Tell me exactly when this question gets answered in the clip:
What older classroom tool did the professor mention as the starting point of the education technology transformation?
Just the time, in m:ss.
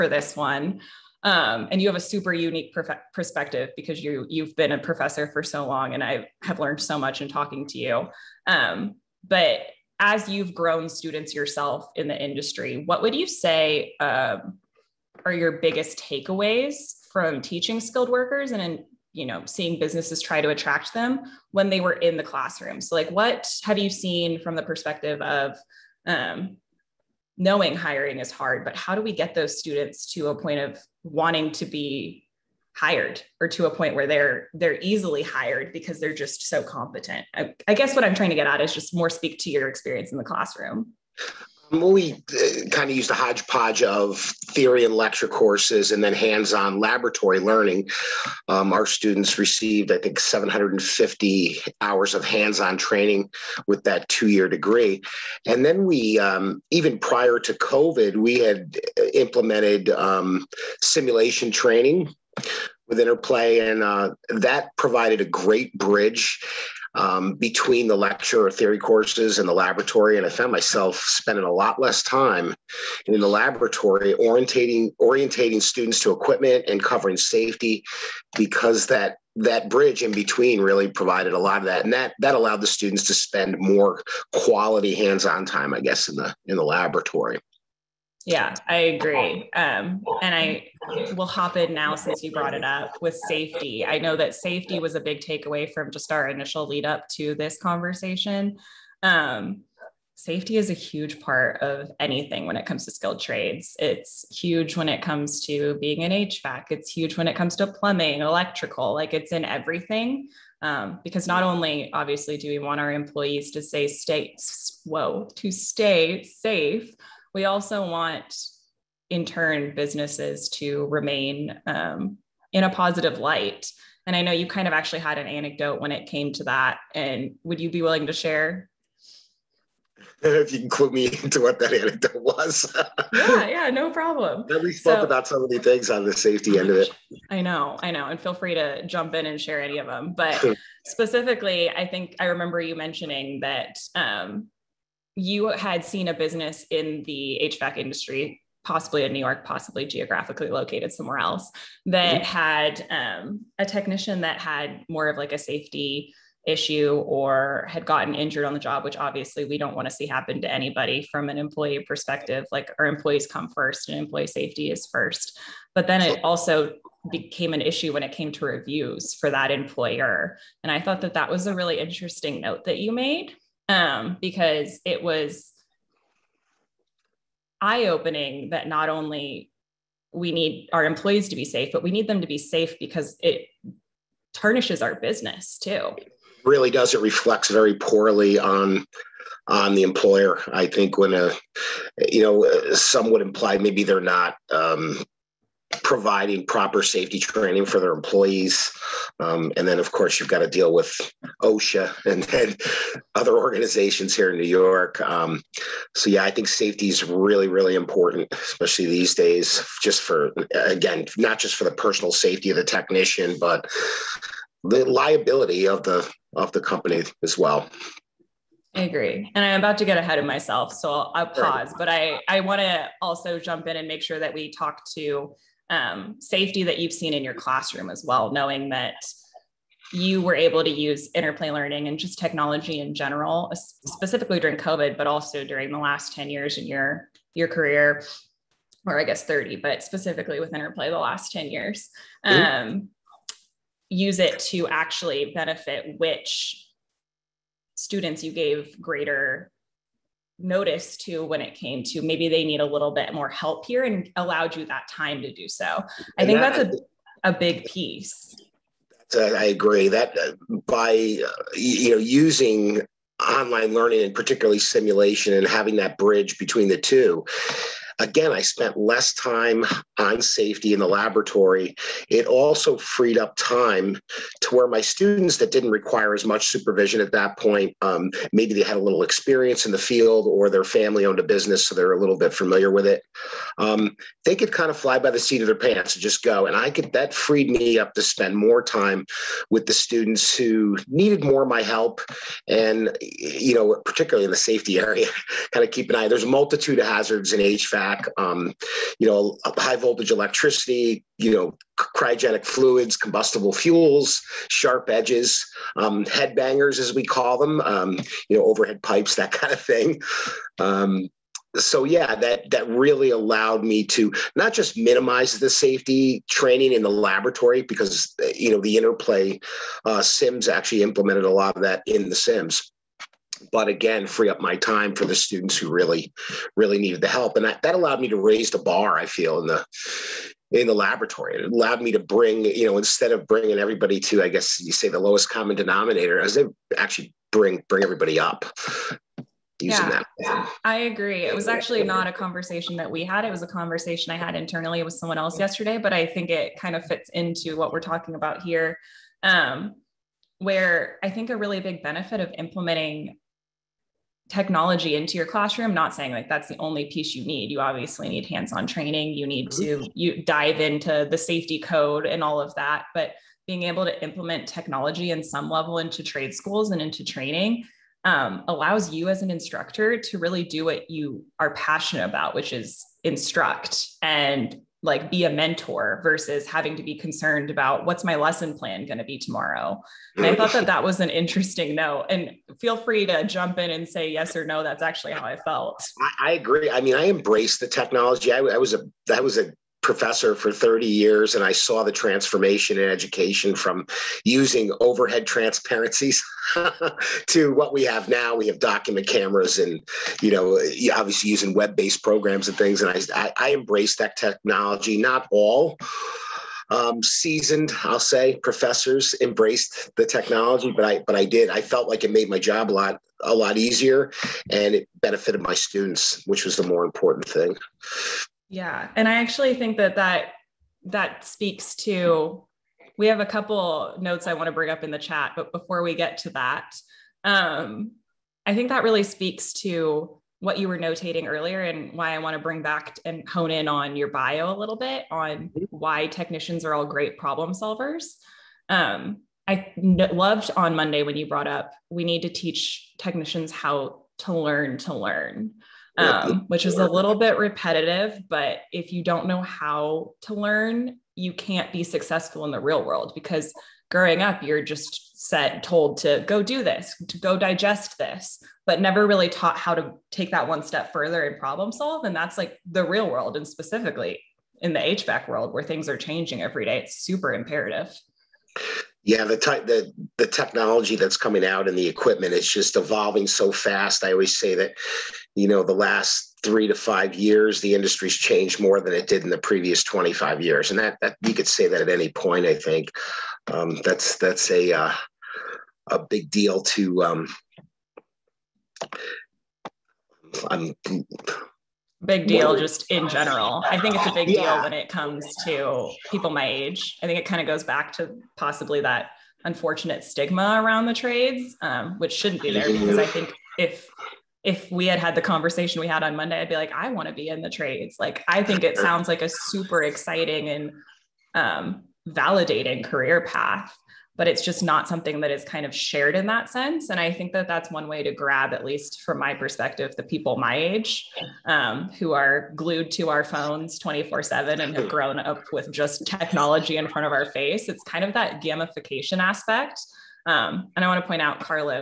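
6:34.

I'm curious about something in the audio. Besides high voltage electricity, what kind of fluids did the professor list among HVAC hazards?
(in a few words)
Cryogenic fluids.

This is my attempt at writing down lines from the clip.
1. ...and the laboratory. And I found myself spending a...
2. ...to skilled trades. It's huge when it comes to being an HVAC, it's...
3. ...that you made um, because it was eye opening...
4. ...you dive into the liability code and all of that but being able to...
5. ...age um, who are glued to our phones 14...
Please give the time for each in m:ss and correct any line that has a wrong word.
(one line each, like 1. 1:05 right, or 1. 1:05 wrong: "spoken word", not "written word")
1. 1:09 right
2. 1:42 right
3. 2:52 right
4. 5:59 wrong: "safety", not "liability"
5. 8:40 wrong: "24", not "14".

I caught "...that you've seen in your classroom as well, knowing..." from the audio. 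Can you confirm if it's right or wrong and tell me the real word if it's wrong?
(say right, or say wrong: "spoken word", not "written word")
right.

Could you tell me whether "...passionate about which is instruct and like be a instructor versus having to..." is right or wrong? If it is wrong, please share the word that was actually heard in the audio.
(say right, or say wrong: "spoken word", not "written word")
wrong: "mentor", not "instructor".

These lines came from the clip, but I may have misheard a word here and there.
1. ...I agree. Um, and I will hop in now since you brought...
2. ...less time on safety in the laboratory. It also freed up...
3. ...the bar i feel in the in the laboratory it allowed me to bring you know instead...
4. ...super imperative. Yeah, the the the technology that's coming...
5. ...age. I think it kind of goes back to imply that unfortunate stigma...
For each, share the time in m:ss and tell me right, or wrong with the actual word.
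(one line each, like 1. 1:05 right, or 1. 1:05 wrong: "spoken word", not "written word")
1. 1:28 right
2. 4:28 right
3. 5:28 right
4. 7:46 right
5. 8:16 wrong: "possibly", not "imply".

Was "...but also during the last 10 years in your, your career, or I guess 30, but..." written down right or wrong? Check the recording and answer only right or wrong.
right.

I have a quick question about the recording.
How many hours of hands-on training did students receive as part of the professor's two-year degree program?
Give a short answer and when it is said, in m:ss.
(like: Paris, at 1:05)
750, at 0:50.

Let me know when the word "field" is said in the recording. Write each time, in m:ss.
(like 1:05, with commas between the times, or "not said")
4:39.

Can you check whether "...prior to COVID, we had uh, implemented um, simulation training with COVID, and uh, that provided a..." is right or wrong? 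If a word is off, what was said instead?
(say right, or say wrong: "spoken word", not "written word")
wrong: "Interplay", not "COVID".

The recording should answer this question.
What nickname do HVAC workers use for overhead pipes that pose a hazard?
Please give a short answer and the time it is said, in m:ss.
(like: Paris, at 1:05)
Headbangers, at 5:06.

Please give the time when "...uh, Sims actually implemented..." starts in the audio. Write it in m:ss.
5:19.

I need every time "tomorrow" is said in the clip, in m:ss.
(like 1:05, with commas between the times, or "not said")
6:19.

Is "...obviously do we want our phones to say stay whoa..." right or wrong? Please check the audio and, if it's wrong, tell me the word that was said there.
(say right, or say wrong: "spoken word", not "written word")
wrong: "employees", not "phones".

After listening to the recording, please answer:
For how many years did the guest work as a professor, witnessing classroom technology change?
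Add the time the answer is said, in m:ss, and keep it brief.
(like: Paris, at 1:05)
30, at 6:30.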